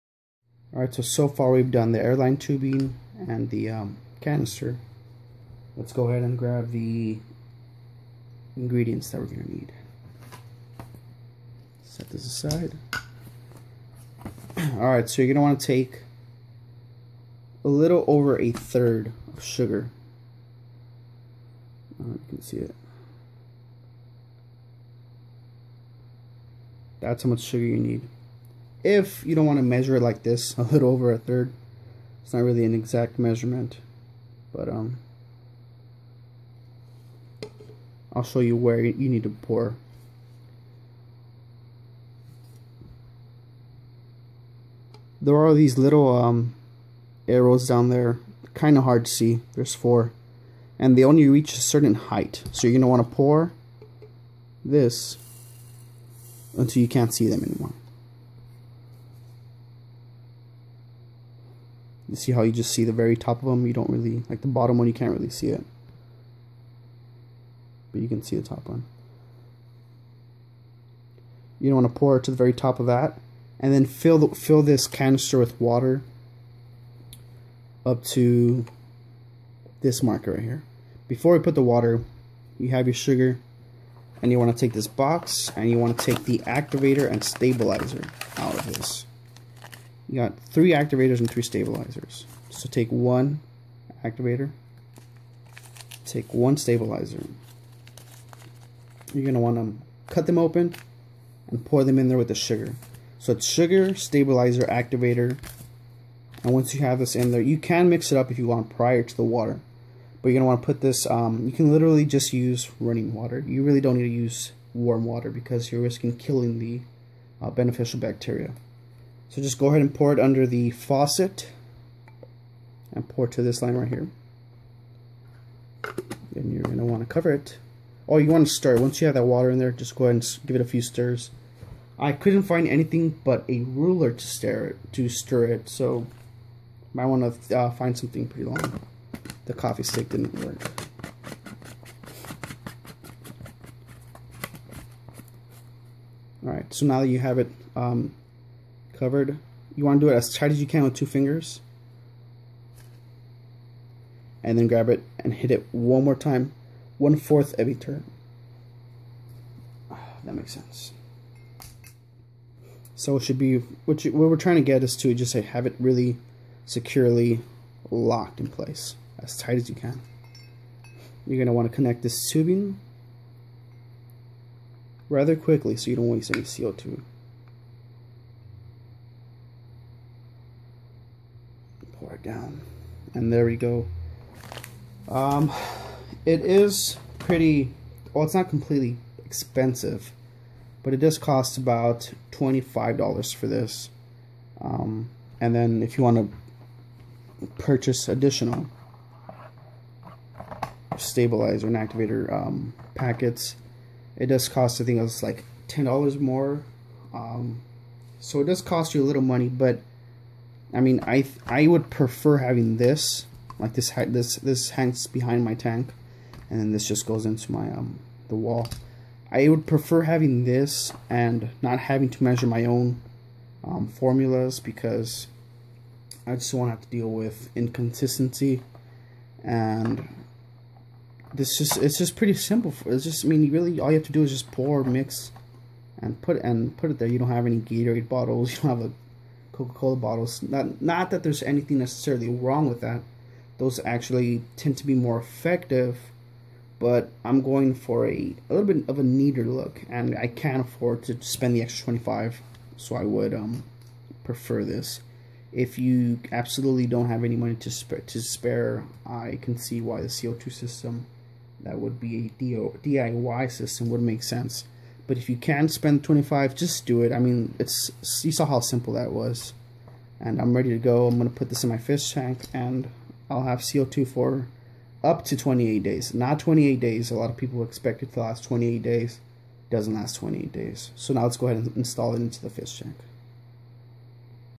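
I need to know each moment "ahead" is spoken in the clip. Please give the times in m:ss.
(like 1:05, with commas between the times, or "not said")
0:06, 1:59, 2:10, 4:41.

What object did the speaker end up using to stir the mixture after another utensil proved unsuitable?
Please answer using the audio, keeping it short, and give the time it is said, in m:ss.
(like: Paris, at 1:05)
a ruler, at 2:13.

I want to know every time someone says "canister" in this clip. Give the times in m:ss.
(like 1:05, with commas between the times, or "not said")
0:04, 1:14.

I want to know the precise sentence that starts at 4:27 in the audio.
I mean, it's you saw how simple that was.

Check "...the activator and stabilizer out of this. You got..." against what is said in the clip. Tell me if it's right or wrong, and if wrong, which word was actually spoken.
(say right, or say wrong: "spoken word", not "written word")
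right.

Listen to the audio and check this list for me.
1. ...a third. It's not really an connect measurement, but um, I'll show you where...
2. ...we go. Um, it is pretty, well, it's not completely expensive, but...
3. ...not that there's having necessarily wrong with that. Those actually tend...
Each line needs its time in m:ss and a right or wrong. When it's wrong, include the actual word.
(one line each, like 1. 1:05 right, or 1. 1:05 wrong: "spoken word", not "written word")
1. 0:31 wrong: "exact", not "connect"
2. 3:03 right
3. 4:00 wrong: "anything", not "having".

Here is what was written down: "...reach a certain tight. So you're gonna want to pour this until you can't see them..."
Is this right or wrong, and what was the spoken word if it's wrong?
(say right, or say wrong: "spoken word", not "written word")
wrong: "height", not "tight".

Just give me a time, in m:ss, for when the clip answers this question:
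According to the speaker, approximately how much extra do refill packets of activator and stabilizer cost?
3:25.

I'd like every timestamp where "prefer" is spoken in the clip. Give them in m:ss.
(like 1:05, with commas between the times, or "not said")
3:31, 3:39, 4:14.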